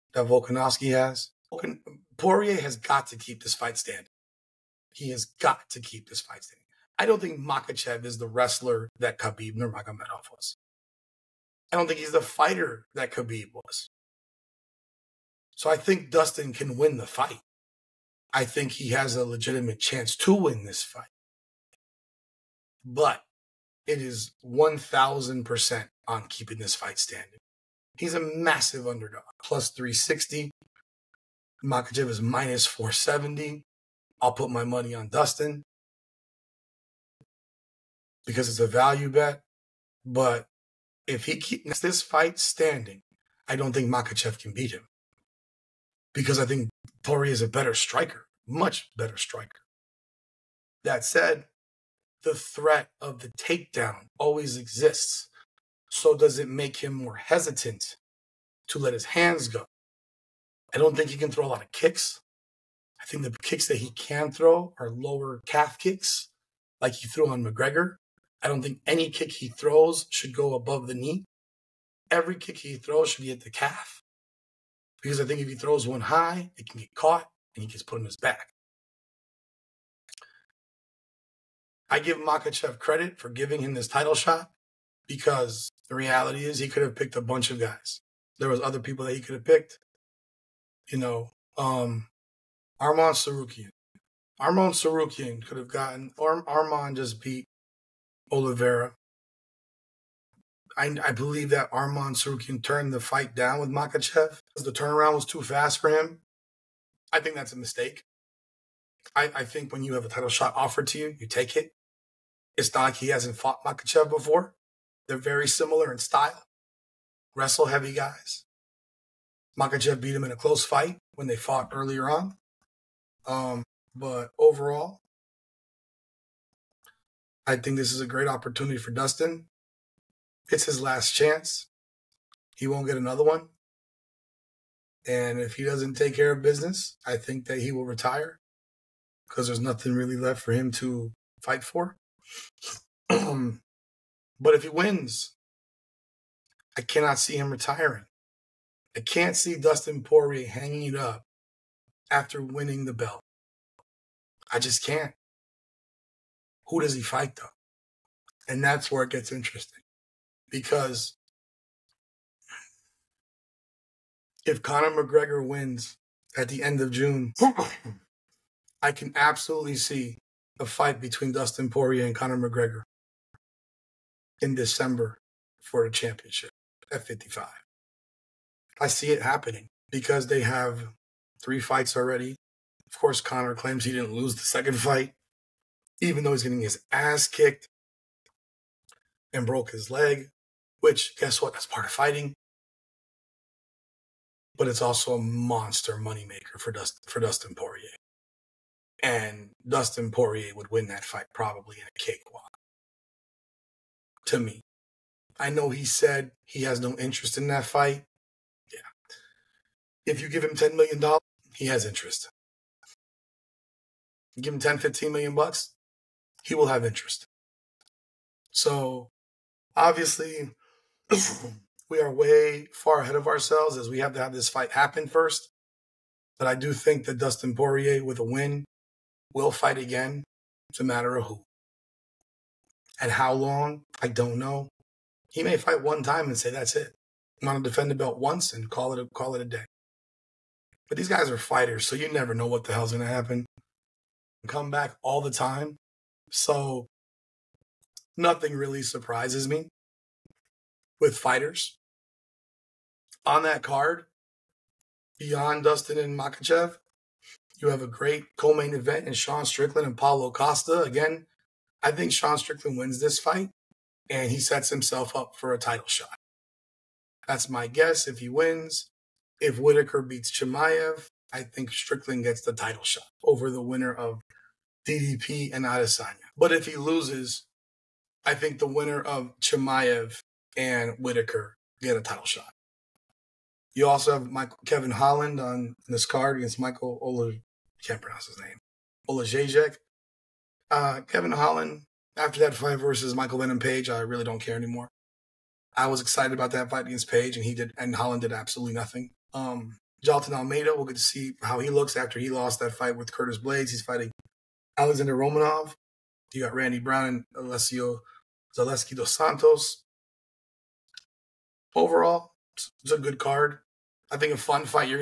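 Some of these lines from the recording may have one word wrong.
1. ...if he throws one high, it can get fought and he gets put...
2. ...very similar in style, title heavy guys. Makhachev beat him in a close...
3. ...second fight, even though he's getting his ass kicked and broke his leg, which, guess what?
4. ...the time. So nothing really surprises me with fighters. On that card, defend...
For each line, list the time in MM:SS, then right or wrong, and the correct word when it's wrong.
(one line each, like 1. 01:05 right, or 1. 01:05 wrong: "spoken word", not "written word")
1. 01:15 wrong: "caught", not "fought"
2. 01:55 wrong: "wrestle", not "title"
3. 03:04 right
4. 04:05 wrong: "beyond", not "defend".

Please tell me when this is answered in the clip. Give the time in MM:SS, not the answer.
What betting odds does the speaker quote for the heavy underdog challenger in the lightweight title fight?
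00:29.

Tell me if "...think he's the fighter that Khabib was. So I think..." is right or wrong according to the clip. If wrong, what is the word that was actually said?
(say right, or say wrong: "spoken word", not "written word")
right.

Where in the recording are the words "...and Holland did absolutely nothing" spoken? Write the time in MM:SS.
04:57.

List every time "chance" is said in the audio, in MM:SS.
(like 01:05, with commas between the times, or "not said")
00:19, 02:11.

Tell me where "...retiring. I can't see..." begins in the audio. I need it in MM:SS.
02:27.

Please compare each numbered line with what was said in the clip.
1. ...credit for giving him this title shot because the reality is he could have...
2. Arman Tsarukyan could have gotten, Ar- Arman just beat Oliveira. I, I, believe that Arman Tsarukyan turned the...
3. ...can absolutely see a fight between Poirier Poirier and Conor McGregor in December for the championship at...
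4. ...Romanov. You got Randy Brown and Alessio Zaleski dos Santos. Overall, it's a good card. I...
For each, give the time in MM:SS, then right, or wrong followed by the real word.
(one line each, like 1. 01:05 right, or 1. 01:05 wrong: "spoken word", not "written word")
1. 01:22 right
2. 01:34 right
3. 02:48 wrong: "Dustin", not "Poirier"
4. 05:05 right.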